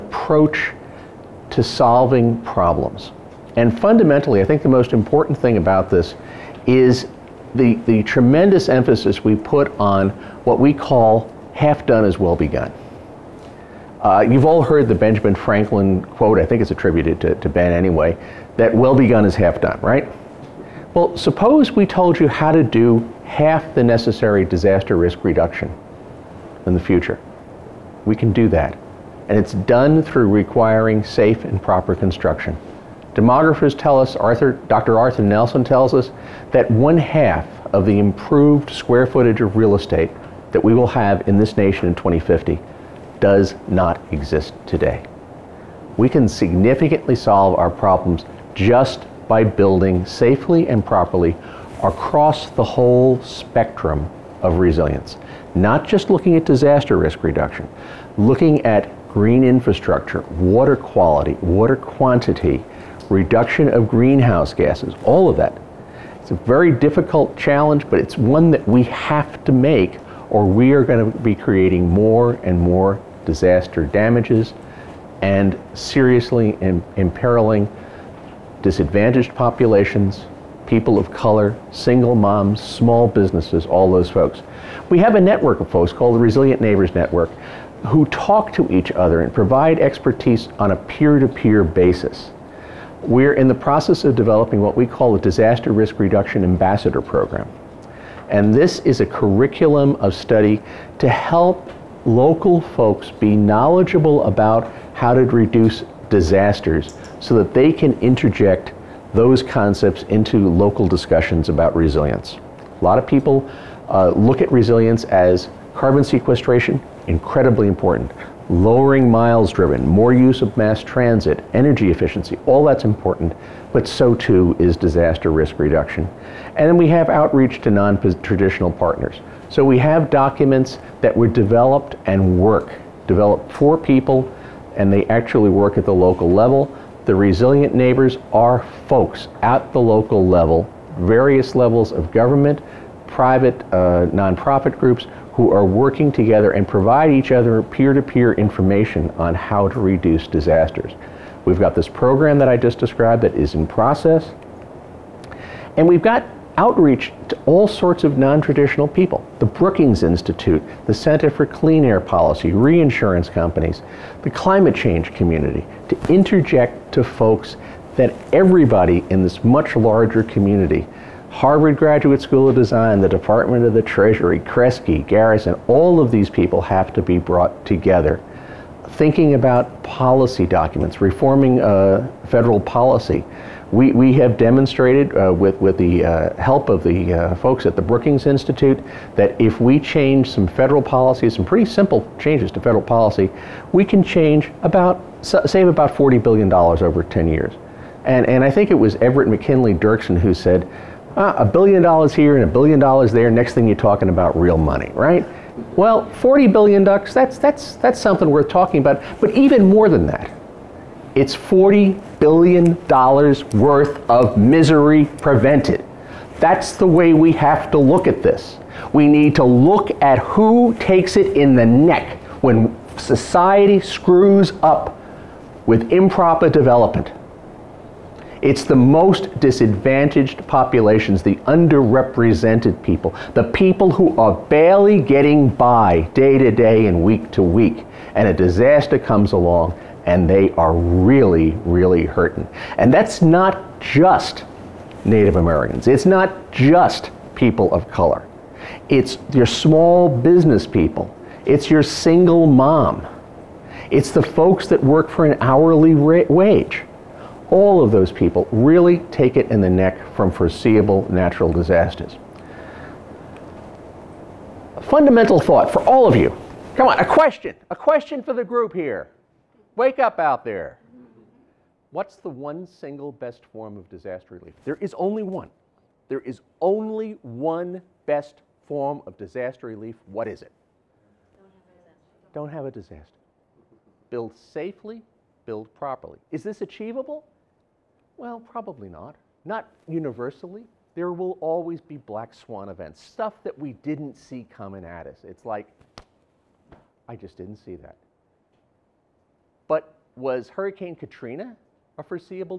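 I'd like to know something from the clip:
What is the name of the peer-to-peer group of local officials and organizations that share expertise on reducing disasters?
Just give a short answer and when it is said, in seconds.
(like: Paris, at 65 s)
Resilient Neighbors Network, at 86 s.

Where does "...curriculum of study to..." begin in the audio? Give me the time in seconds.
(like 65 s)
99 s.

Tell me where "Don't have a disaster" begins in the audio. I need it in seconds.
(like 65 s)
282 s.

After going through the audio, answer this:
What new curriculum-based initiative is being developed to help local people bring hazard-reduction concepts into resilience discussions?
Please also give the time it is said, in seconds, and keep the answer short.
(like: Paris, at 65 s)
Disaster Risk Reduction Ambassador Program, at 95 s.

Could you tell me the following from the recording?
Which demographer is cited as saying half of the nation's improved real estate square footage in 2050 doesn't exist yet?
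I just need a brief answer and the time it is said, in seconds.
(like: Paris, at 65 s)
Dr. Arthur Nelson, at 34 s.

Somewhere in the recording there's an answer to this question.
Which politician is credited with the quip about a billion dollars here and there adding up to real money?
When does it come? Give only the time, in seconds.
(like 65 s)
198 s.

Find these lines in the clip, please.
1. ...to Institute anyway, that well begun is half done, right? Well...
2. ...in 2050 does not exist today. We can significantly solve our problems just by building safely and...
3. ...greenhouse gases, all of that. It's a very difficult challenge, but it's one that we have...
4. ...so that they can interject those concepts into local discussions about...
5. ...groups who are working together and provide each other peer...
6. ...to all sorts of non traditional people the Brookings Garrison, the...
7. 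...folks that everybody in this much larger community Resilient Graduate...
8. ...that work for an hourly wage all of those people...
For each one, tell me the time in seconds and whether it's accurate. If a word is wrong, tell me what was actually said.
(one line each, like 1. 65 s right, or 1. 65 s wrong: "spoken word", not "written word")
1. 17 s wrong: "Ben", not "Institute"
2. 41 s right
3. 63 s right
4. 107 s right
5. 144 s right
6. 157 s wrong: "Institute", not "Garrison"
7. 167 s wrong: "Harvard", not "Resilient"
8. 254 s right.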